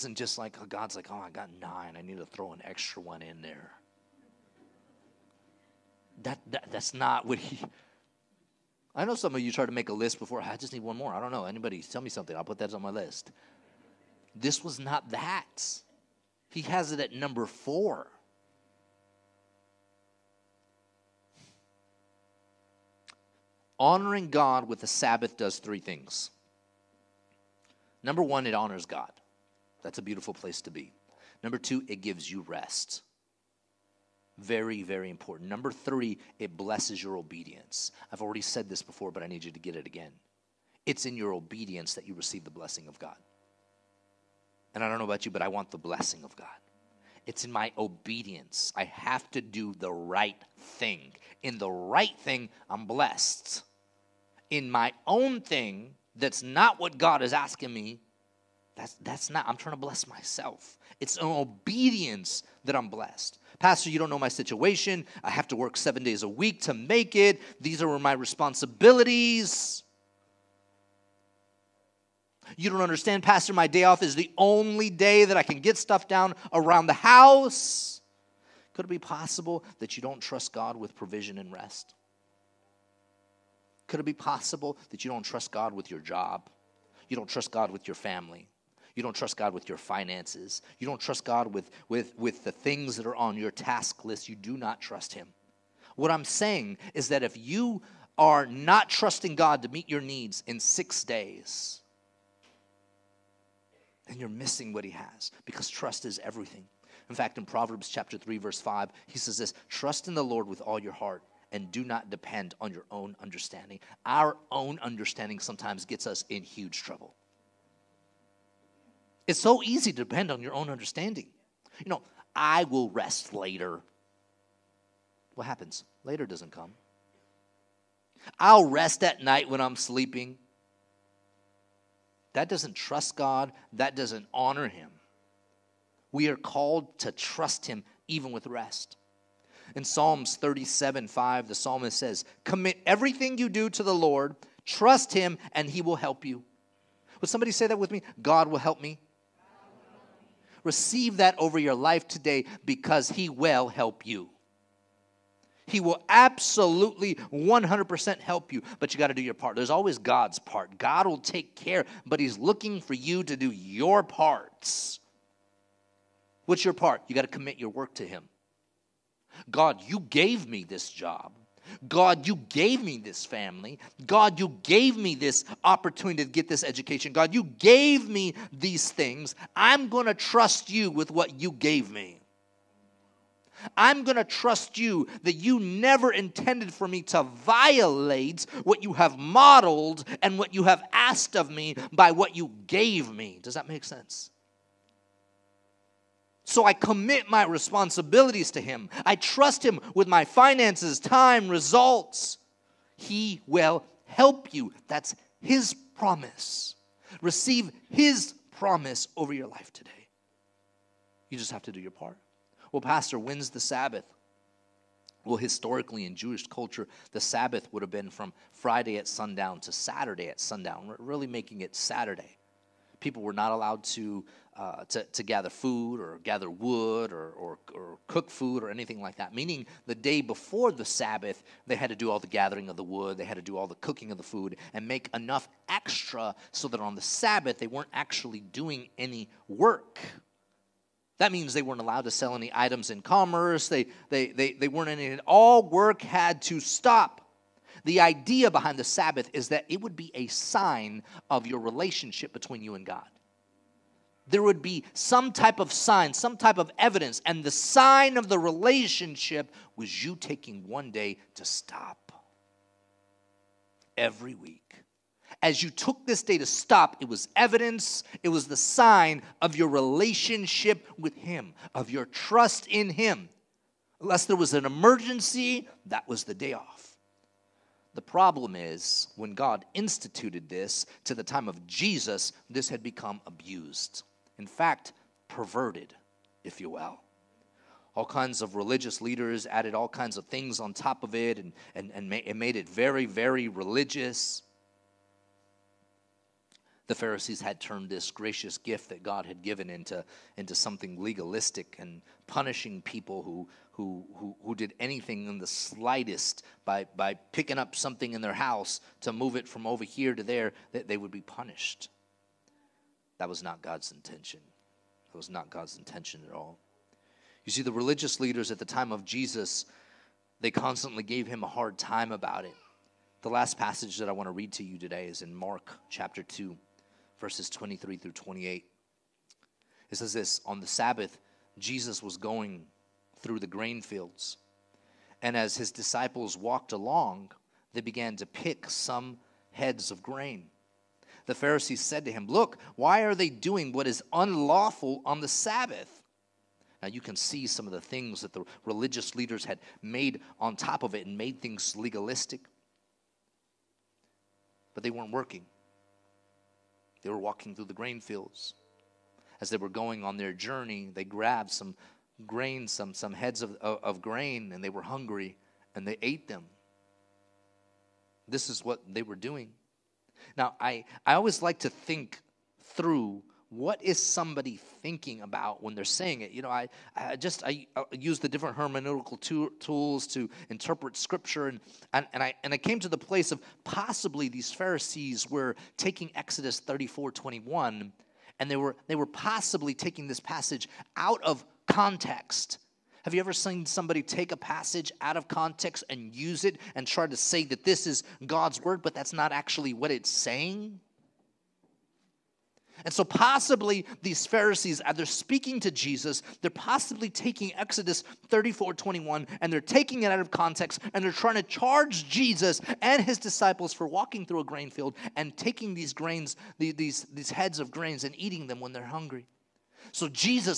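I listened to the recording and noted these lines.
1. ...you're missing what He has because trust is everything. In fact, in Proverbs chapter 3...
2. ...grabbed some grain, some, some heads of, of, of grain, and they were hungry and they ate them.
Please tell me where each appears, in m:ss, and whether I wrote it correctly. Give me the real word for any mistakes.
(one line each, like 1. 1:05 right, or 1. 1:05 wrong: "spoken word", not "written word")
1. 1:44 right
2. 6:01 right.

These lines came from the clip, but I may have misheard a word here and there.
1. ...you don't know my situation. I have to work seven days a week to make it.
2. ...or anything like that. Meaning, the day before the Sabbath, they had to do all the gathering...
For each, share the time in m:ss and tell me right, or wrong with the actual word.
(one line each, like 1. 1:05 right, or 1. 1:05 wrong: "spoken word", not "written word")
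1. 1:03 right
2. 3:48 right.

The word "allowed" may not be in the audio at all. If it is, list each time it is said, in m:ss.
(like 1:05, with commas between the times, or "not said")
3:43, 4:01.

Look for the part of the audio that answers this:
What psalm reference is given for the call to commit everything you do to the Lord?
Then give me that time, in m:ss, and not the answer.
2:19.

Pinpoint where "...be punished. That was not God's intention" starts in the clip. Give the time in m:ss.
5:11.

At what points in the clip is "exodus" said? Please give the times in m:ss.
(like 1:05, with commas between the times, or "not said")
6:26, 6:47.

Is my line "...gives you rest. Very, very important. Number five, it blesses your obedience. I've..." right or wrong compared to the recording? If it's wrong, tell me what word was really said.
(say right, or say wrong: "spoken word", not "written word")
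wrong: "three", not "five".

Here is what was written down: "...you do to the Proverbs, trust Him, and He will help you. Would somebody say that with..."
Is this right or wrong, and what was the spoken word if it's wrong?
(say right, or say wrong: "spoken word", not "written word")
wrong: "Lord", not "Proverbs".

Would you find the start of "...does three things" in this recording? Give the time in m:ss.
0:25.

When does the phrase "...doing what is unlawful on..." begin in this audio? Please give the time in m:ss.
5:43.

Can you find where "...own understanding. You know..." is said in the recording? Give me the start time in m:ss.
2:00.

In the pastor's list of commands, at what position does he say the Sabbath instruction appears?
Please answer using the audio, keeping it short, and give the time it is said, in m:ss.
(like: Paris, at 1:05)
4, at 0:17.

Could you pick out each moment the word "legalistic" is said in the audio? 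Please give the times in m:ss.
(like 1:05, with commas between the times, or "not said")
5:01, 5:51.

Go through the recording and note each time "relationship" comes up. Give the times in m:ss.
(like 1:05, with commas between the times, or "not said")
4:11, 4:18, 4:29.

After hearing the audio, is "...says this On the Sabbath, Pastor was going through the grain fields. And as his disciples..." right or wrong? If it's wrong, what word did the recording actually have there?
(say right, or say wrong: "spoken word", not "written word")
wrong: "Jesus", not "Pastor".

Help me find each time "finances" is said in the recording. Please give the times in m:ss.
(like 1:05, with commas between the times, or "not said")
1:29, 3:20.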